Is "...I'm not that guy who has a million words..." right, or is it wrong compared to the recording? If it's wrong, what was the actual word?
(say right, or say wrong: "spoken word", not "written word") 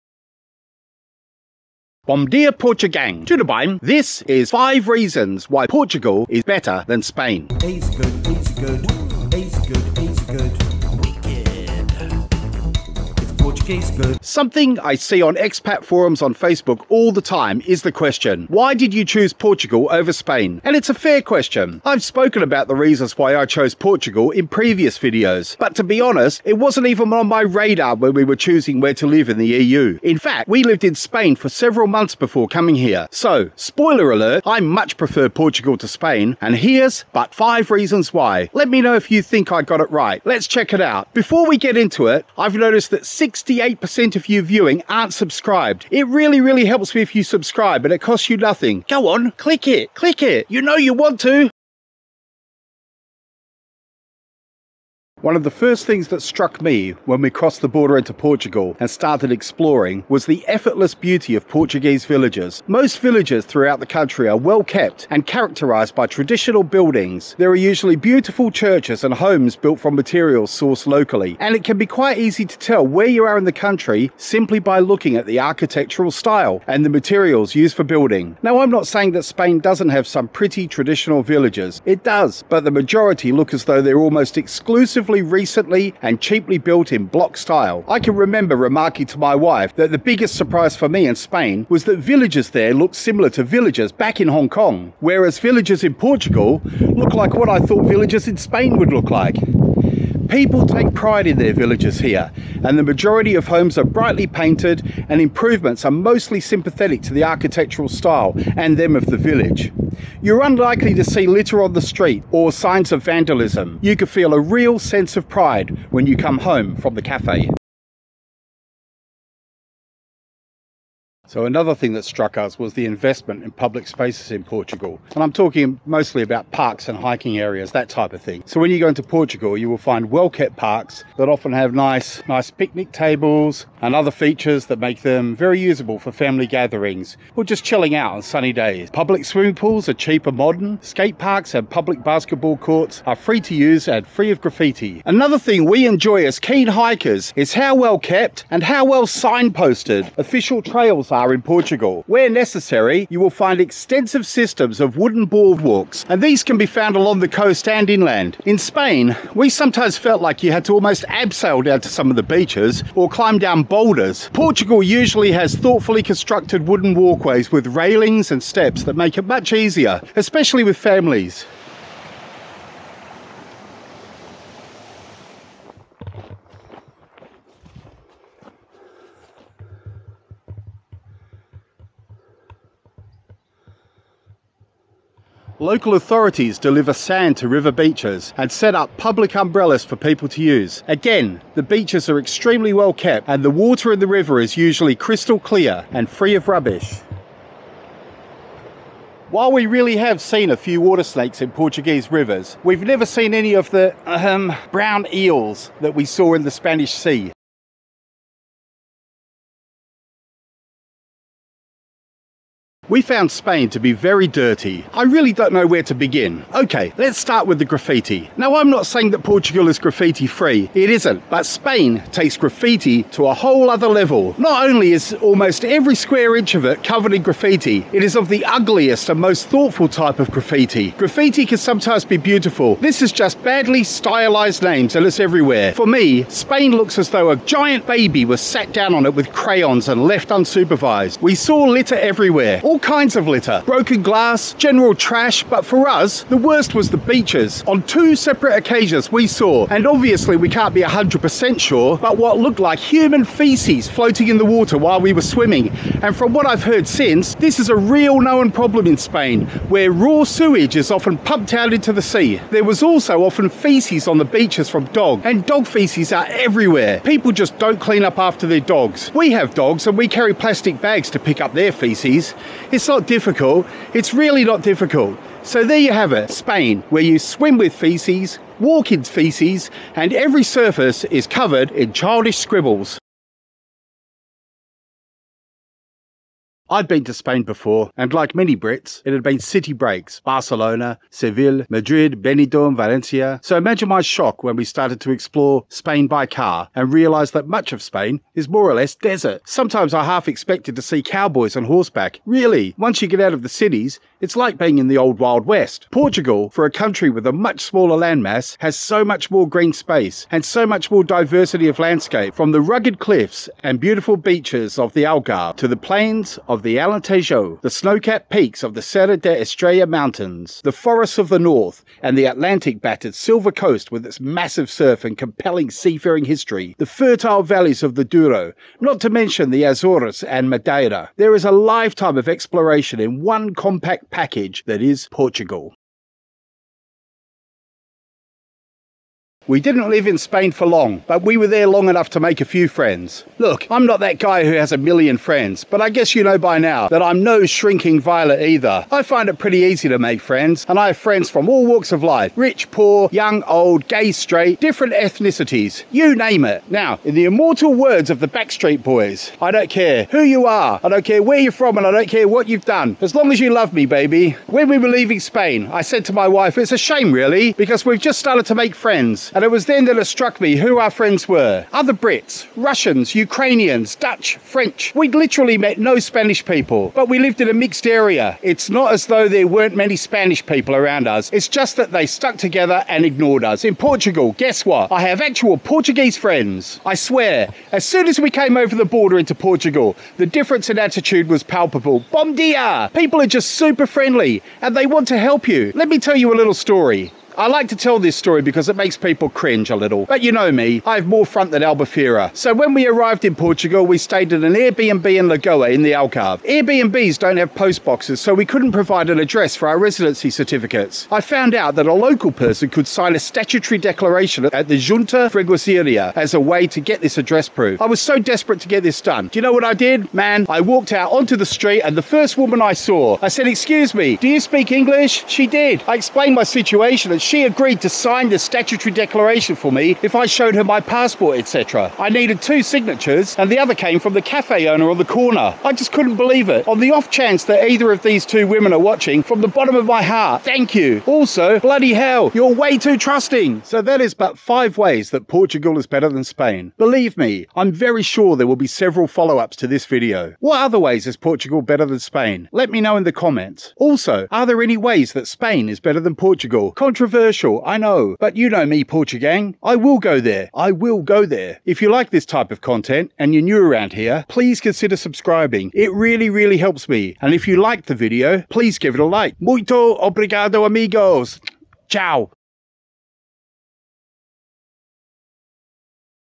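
wrong: "friends", not "words".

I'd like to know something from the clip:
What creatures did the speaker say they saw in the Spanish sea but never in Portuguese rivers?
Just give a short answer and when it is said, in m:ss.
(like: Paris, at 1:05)
brown eels, at 3:24.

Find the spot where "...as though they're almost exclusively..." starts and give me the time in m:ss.
1:23.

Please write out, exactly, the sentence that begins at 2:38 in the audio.
In Spain, we sometimes felt like you had to almost abseil down to some of the beaches or climb down boulders.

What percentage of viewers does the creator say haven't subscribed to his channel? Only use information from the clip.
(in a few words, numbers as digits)
98%.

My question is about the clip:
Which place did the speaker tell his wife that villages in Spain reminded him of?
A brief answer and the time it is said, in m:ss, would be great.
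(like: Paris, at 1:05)
Hong Kong, at 1:34.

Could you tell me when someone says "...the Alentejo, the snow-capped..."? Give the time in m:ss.
5:16.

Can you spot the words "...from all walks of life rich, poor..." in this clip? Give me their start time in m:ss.
5:51.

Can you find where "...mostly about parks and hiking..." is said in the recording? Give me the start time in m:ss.
2:05.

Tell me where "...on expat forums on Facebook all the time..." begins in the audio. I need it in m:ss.
0:15.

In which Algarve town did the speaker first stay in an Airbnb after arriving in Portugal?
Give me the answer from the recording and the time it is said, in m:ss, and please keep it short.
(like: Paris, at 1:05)
Lagoa, at 6:45.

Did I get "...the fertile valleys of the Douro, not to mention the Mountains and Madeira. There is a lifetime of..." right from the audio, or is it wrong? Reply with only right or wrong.
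wrong.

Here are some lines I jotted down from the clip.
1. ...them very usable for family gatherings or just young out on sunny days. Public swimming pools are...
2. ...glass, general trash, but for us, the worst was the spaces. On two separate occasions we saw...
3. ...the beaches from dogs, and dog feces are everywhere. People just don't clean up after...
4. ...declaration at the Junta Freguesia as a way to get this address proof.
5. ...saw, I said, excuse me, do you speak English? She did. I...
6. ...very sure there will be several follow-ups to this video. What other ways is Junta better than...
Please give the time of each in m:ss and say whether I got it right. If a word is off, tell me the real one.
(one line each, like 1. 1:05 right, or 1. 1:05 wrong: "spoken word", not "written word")
1. 2:15 wrong: "chilling", not "young"
2. 4:04 wrong: "beaches", not "spaces"
3. 4:24 right
4. 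6:53 right
5. 7:02 right
6. 7:27 wrong: "Portugal", not "Junta".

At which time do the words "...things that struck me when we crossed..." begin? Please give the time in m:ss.
0:55.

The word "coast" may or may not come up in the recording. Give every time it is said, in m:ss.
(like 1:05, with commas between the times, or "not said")
2:37, 5:23.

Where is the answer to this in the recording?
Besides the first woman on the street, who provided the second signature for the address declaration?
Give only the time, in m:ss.
7:14.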